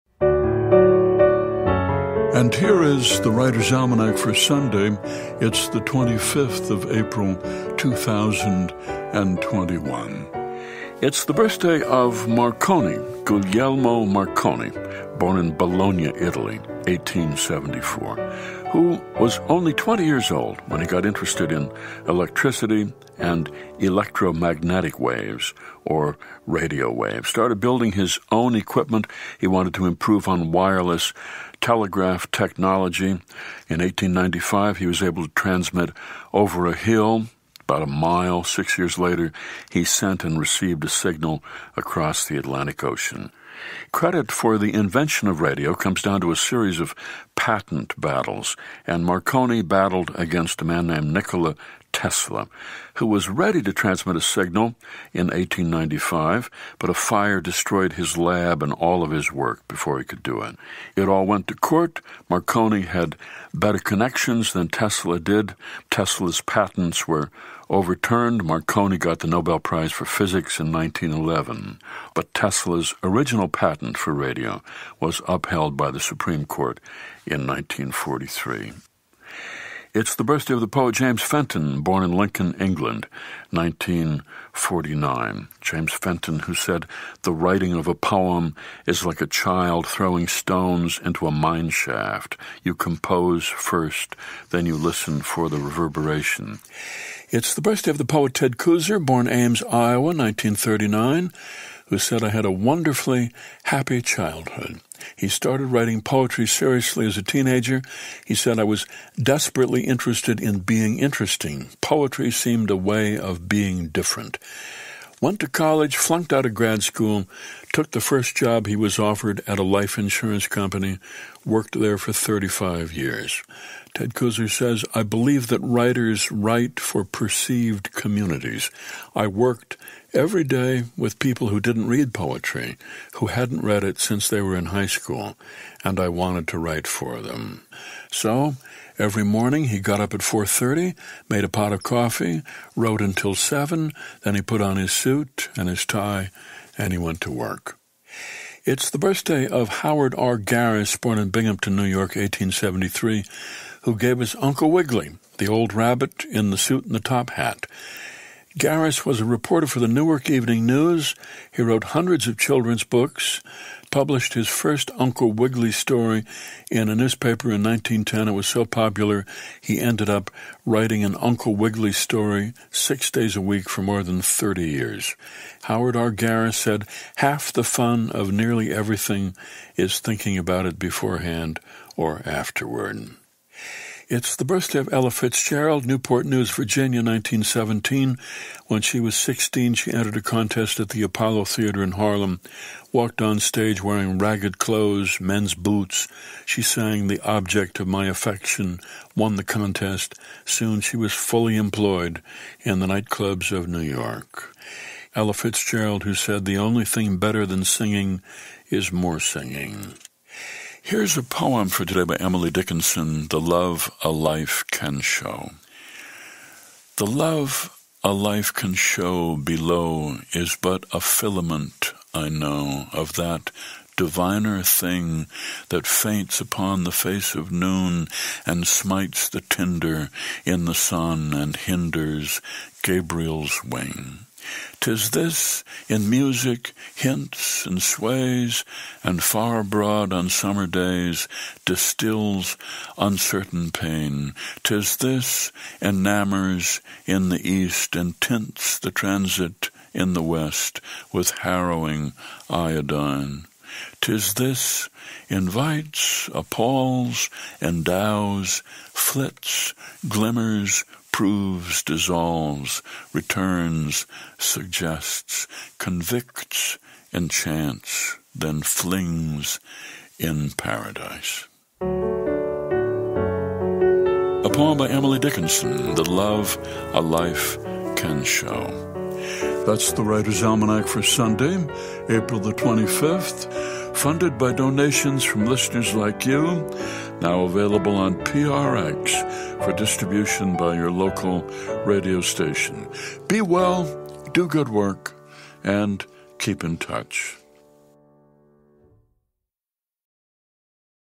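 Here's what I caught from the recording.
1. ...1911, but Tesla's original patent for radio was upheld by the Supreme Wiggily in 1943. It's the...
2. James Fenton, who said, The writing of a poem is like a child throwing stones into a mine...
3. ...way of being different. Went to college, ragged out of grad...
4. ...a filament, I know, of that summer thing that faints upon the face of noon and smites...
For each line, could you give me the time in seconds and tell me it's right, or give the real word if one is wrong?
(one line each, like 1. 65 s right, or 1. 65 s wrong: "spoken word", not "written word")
1. 70 s wrong: "Court", not "Wiggily"
2. 85 s right
3. 112 s wrong: "flunked", not "ragged"
4. 220 s wrong: "diviner", not "summer".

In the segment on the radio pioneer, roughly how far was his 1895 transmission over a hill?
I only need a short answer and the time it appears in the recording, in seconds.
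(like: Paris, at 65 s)
About a mile, at 37 s.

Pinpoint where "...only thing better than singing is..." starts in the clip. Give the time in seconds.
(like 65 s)
206 s.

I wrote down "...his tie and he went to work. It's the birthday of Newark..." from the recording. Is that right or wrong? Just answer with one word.
wrong.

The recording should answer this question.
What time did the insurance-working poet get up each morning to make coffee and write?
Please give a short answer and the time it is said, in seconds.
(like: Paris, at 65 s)
4:30, at 140 s.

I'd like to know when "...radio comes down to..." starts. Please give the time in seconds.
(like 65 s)
45 s.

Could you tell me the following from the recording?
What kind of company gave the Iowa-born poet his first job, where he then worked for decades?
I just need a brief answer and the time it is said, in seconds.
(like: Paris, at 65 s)
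Life insurance company, at 119 s.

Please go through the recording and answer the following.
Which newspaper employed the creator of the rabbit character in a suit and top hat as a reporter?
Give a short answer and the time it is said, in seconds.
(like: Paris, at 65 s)
Newark Evening News, at 159 s.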